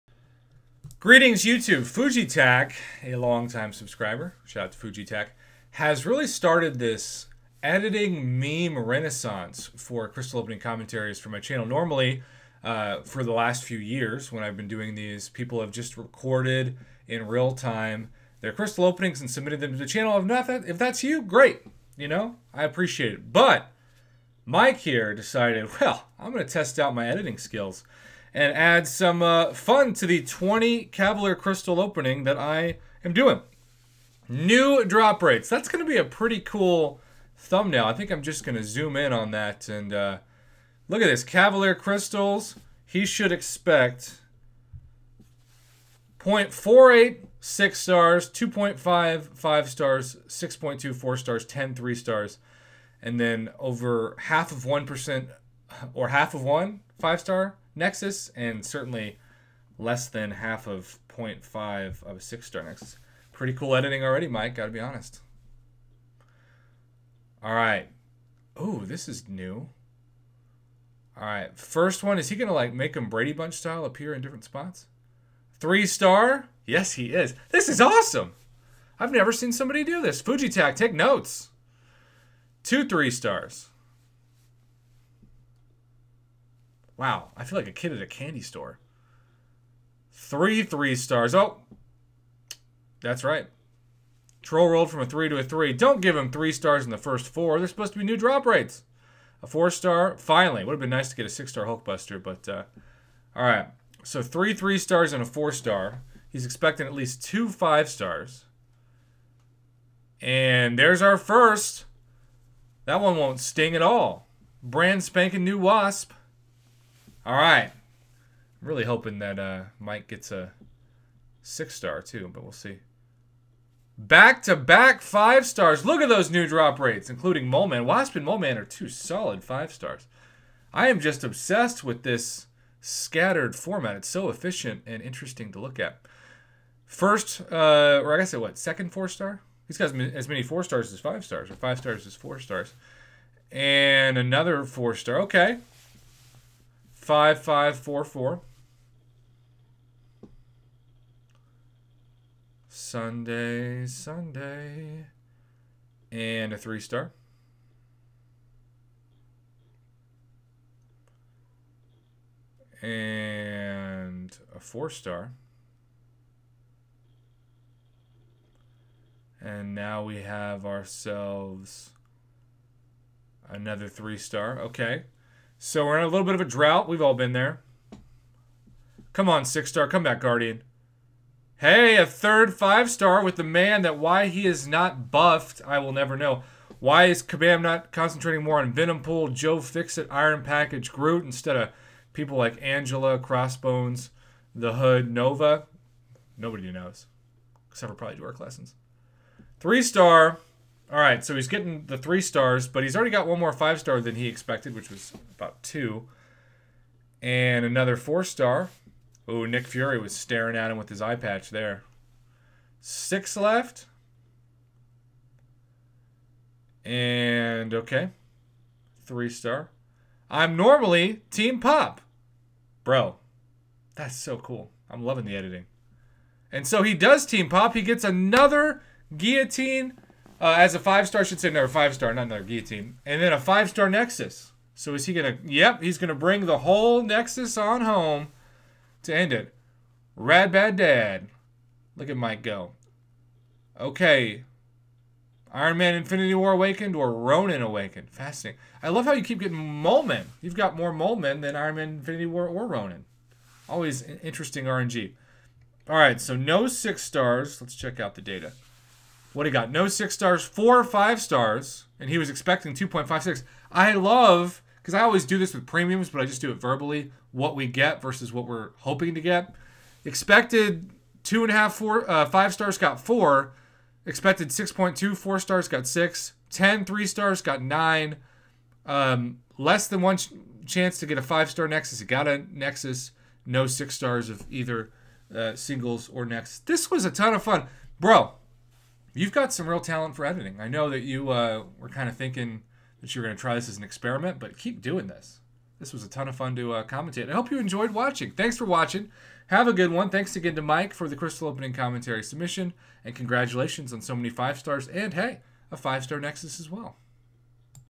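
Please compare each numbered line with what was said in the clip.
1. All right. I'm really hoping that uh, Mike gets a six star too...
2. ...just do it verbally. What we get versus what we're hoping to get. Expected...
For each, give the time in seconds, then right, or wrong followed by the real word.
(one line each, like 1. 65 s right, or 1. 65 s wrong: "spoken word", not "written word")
1. 117 s right
2. 266 s right.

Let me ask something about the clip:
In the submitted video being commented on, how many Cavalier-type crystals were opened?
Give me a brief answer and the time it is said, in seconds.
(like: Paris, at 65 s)
20, at 30 s.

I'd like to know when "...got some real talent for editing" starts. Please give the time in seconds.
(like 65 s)
289 s.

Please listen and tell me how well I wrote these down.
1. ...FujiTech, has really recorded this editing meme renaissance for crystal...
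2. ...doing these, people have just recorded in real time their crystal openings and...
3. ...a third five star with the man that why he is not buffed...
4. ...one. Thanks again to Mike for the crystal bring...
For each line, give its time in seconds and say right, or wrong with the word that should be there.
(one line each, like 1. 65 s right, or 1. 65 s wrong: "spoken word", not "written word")
1. 4 s wrong: "started", not "recorded"
2. 14 s right
3. 181 s right
4. 299 s wrong: "opening", not "bring".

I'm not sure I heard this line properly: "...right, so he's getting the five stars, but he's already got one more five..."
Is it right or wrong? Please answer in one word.
wrong.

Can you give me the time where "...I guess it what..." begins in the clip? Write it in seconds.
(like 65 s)
138 s.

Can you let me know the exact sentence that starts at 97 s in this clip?
They're supposed to be new drop rates.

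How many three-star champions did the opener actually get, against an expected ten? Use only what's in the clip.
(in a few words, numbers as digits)
9.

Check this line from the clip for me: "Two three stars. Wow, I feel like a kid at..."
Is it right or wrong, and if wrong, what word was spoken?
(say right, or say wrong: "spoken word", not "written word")
right.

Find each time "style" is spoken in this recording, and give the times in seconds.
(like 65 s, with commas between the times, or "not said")
73 s.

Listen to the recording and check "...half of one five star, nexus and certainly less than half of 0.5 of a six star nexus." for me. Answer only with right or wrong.
right.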